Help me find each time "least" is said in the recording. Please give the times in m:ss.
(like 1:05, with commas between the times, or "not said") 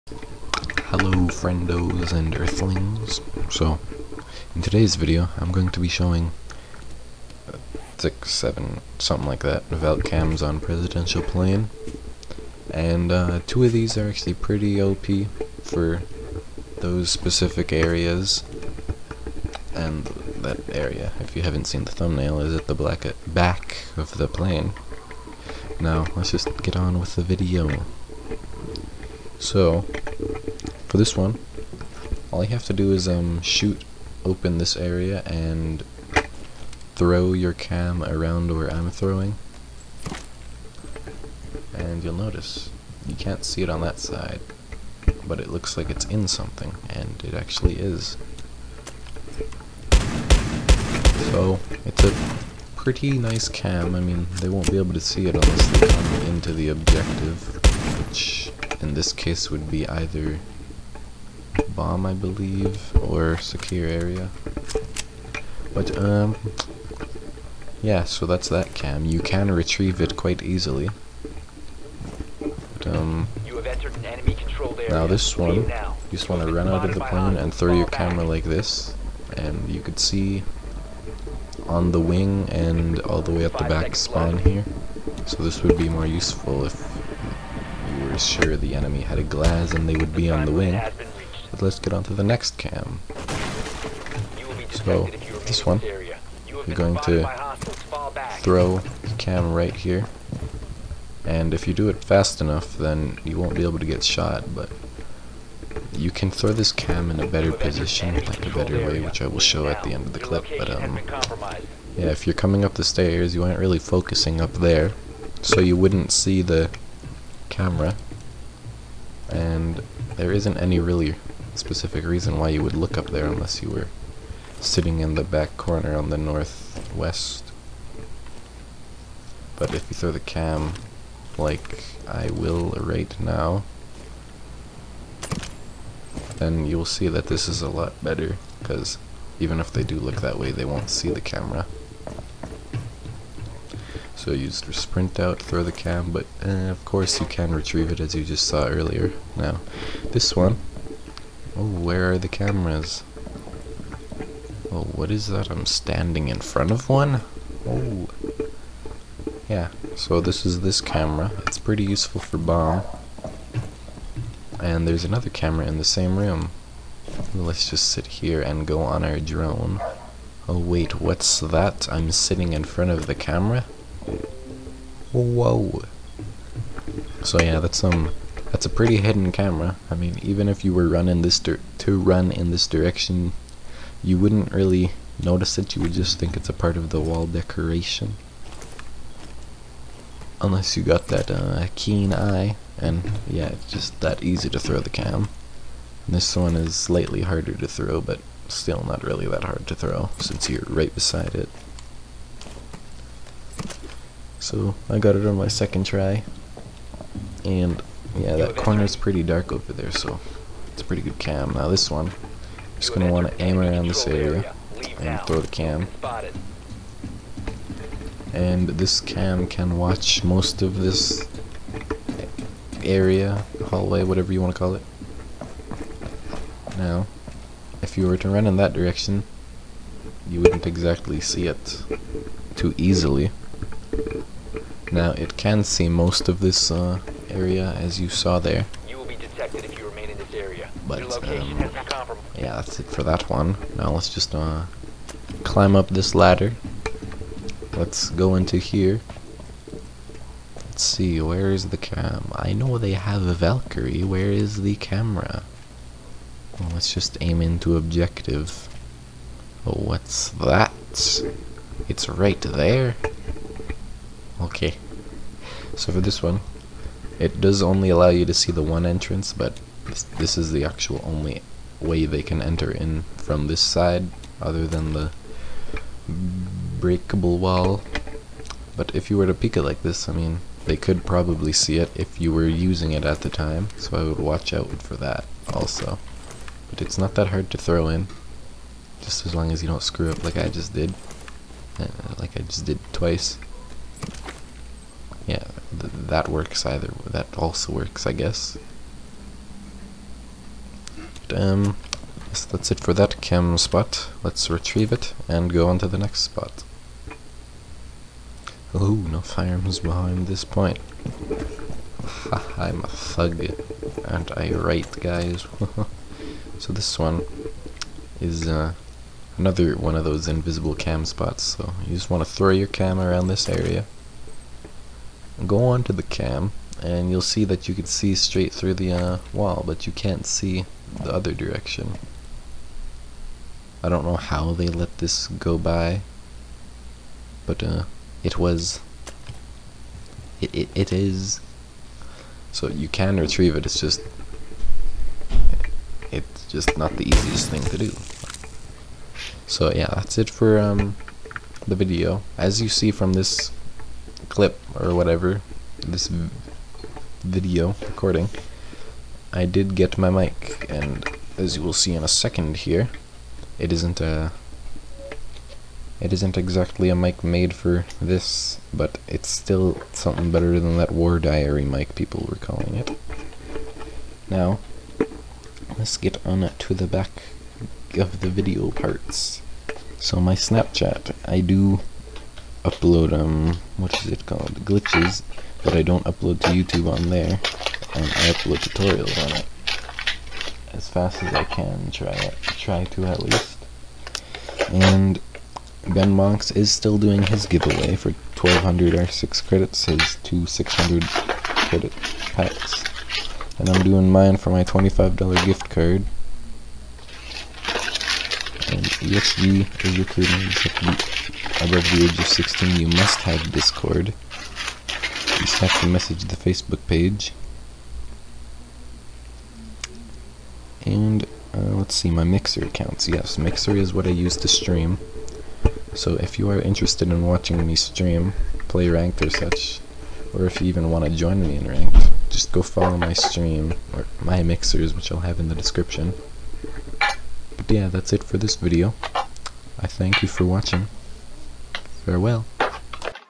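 6:33.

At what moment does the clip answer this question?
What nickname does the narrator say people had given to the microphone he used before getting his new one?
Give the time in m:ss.
6:10.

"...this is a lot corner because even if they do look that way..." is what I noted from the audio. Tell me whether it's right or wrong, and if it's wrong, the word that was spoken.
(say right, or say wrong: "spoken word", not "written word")
wrong: "better", not "corner".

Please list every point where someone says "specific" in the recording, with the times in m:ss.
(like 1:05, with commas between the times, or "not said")
0:17, 2:01.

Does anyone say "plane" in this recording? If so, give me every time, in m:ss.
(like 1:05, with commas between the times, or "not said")
0:11, 0:24, 1:16.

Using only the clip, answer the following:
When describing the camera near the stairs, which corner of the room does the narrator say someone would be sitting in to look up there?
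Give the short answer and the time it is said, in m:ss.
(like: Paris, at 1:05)
northwest, at 2:06.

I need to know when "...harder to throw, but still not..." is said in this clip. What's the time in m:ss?
3:17.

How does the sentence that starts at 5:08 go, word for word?
Oh, no firearms behind this point.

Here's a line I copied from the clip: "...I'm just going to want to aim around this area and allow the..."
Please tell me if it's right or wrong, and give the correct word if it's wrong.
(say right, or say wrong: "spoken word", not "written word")
wrong: "throw", not "allow".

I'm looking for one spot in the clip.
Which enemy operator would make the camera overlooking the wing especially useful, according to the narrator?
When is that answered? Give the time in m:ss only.
1:29.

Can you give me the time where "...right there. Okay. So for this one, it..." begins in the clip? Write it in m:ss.
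4:22.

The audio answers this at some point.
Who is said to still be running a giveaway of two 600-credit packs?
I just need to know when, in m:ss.
6:35.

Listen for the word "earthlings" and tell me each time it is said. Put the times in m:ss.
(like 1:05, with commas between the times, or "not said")
0:02.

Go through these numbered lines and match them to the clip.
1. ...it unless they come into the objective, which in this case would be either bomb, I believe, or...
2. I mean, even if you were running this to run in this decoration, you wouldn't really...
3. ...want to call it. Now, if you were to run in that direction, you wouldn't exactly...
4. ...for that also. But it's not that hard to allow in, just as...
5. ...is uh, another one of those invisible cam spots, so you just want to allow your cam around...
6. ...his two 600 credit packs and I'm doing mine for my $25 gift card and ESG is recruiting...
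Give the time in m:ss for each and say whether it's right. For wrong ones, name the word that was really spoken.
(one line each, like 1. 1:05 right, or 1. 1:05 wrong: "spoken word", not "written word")
1. 0:55 right
2. 2:59 wrong: "direction", not "decoration"
3. 3:44 right
4. 4:44 wrong: "throw", not "allow"
5. 5:18 wrong: "throw", not "allow"
6. 6:39 right.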